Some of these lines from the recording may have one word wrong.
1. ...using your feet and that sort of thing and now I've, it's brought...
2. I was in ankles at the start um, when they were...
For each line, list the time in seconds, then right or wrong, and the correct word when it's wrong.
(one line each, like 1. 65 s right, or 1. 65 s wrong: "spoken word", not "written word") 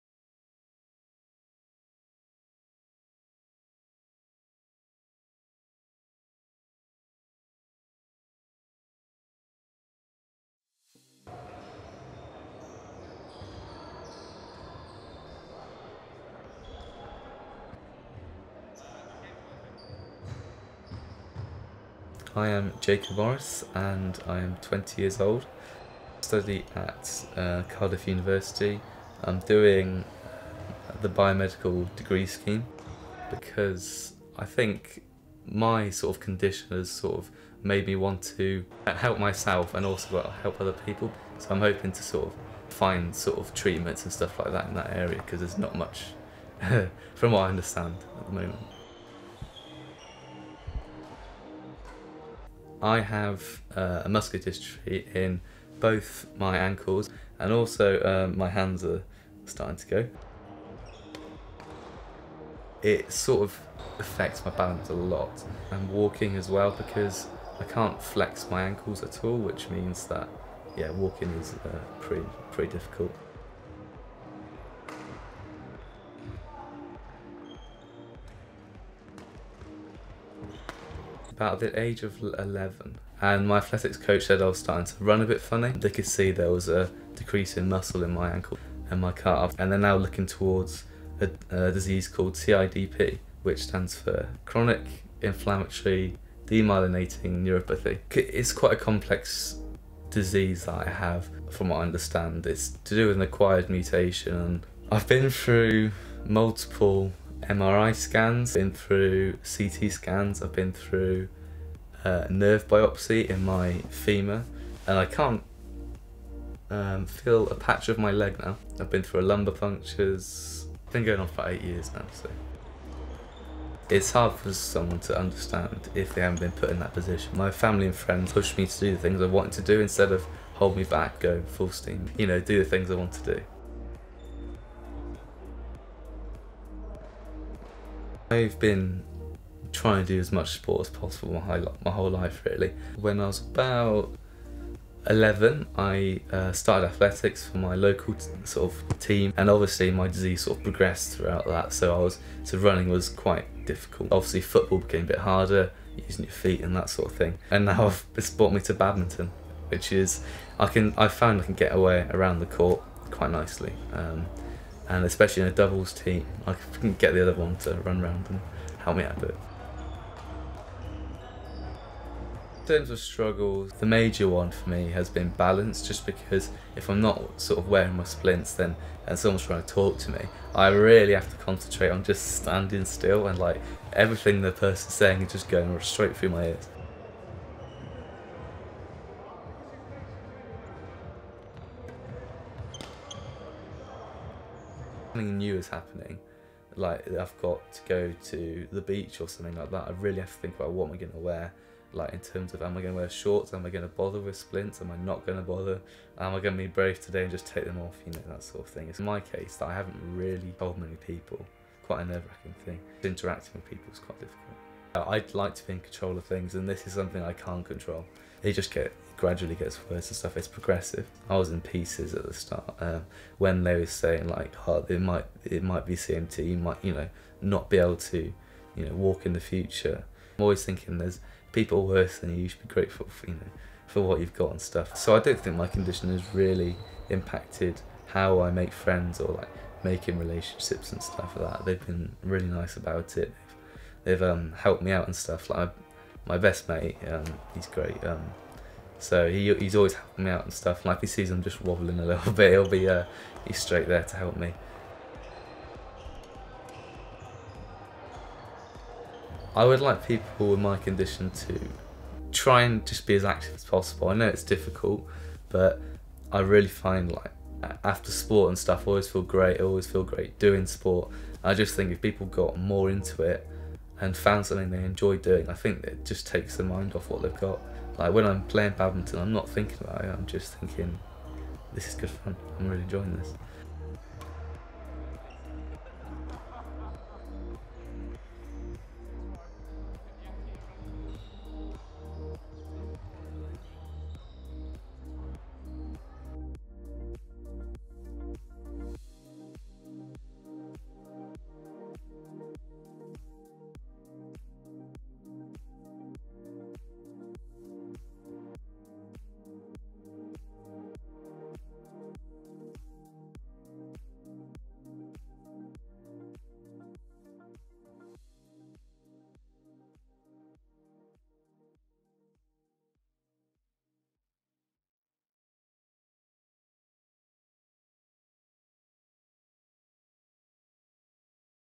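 1. 155 s right
2. 221 s wrong: "pieces", not "ankles".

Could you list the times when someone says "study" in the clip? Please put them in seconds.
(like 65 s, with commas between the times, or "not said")
26 s.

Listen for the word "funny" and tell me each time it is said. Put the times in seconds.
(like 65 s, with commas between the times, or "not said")
85 s.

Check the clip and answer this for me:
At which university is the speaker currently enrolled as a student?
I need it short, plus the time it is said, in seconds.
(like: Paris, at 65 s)
Cardiff University, at 27 s.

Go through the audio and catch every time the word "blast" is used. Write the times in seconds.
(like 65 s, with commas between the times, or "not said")
not said.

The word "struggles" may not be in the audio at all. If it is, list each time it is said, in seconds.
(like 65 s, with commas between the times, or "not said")
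172 s.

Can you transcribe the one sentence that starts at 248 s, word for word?
Um, so he, he's always helping me out and stuff.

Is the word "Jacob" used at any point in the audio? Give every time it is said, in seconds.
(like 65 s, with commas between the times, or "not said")
22 s.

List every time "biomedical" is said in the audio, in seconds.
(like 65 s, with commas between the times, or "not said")
31 s.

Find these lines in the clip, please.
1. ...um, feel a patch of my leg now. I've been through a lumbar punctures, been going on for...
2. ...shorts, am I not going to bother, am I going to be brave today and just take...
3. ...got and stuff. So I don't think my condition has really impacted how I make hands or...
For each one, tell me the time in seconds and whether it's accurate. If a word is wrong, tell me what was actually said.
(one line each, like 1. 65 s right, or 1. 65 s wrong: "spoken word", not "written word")
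1. 116 s right
2. 204 s wrong: "splints", not "shorts"
3. 234 s wrong: "friends", not "hands".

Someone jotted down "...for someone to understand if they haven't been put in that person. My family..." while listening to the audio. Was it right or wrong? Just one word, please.
wrong.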